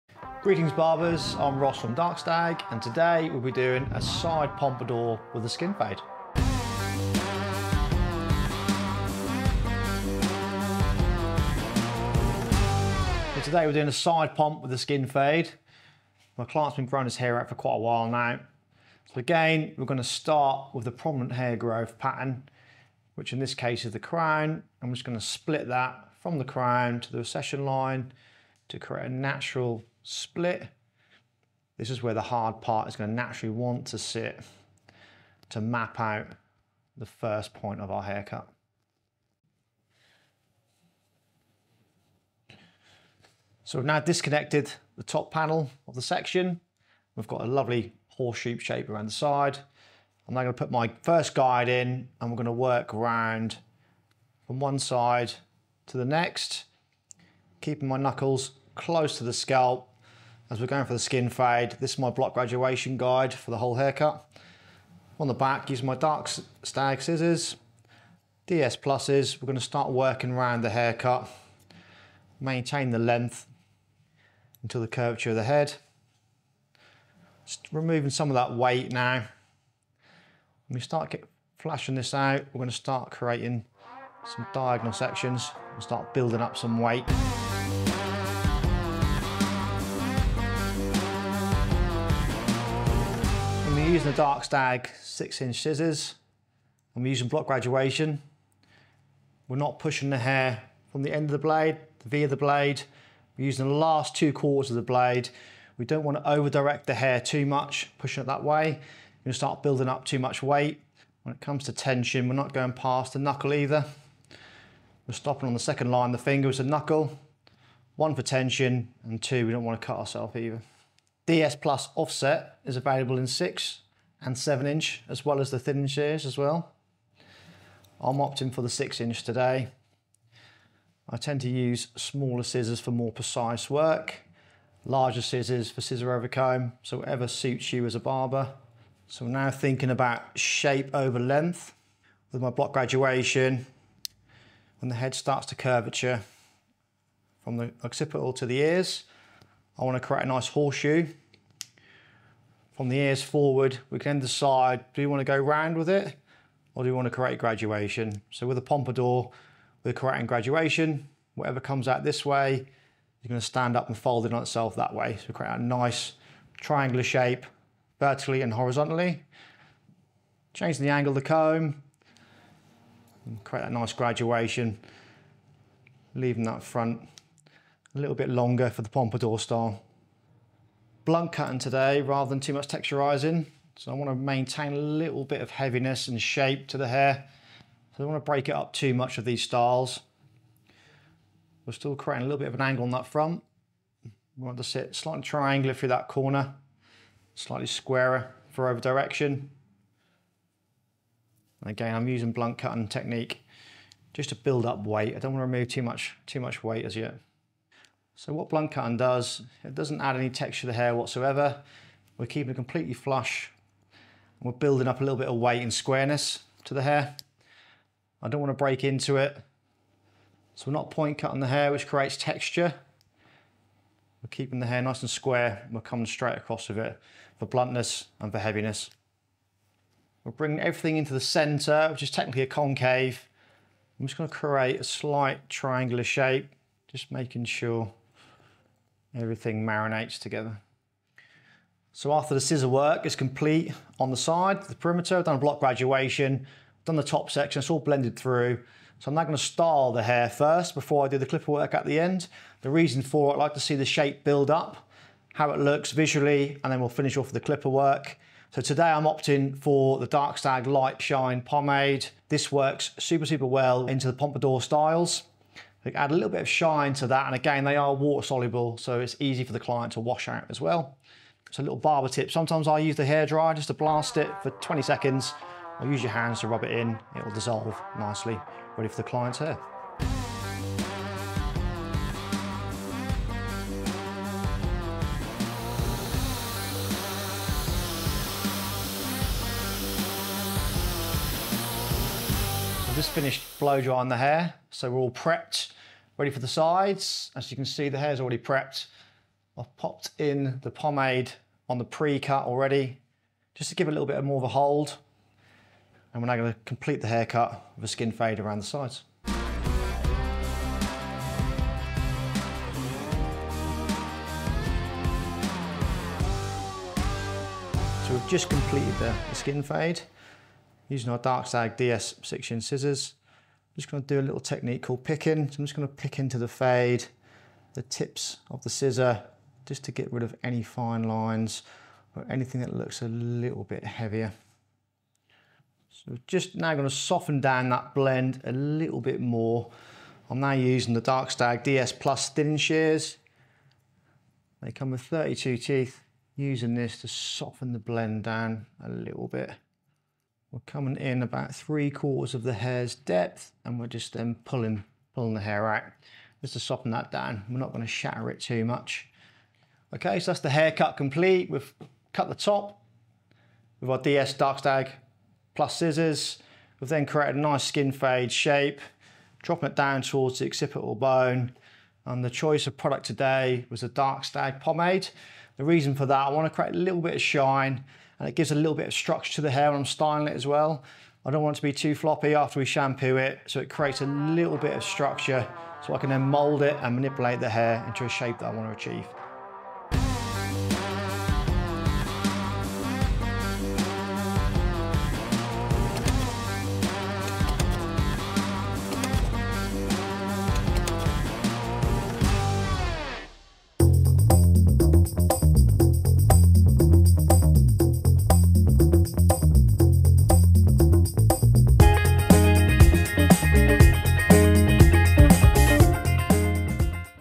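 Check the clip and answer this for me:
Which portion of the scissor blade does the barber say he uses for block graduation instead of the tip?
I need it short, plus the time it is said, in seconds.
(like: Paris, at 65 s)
Last two quarters, at 103 s.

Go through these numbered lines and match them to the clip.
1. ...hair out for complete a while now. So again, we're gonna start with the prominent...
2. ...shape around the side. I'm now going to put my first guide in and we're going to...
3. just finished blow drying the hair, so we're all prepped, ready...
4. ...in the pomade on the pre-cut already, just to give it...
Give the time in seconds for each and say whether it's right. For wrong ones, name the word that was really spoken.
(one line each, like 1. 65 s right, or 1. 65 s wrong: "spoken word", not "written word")
1. 17 s wrong: "quite", not "complete"
2. 48 s right
3. 293 s right
4. 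300 s right.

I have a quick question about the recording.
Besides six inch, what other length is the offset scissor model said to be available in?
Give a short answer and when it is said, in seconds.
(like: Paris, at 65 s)
7 inch, at 124 s.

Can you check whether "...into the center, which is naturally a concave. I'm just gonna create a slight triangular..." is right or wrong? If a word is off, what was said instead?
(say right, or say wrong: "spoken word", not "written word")
wrong: "technically", not "naturally".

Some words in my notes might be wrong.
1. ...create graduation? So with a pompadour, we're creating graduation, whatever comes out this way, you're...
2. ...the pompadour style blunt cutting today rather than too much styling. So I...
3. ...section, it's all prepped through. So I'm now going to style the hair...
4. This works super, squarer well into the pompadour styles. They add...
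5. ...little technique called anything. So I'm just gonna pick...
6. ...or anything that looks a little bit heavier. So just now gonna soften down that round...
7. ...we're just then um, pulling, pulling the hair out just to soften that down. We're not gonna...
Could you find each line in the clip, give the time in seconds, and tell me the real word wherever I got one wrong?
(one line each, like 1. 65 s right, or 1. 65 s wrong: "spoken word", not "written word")
1. 157 s right
2. 178 s wrong: "texturizing", not "styling"
3. 247 s wrong: "blended", not "prepped"
4. 262 s wrong: "super", not "squarer"
5. 324 s wrong: "picking", not "anything"
6. 332 s wrong: "blend", not "round"
7. 353 s right.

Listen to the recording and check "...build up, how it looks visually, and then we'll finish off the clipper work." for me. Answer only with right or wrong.
right.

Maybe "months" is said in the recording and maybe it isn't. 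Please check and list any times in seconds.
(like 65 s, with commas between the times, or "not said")
not said.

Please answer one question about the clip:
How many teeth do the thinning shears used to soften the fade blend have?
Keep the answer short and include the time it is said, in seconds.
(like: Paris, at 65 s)
32, at 345 s.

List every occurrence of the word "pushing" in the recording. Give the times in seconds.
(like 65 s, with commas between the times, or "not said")
99 s, 107 s.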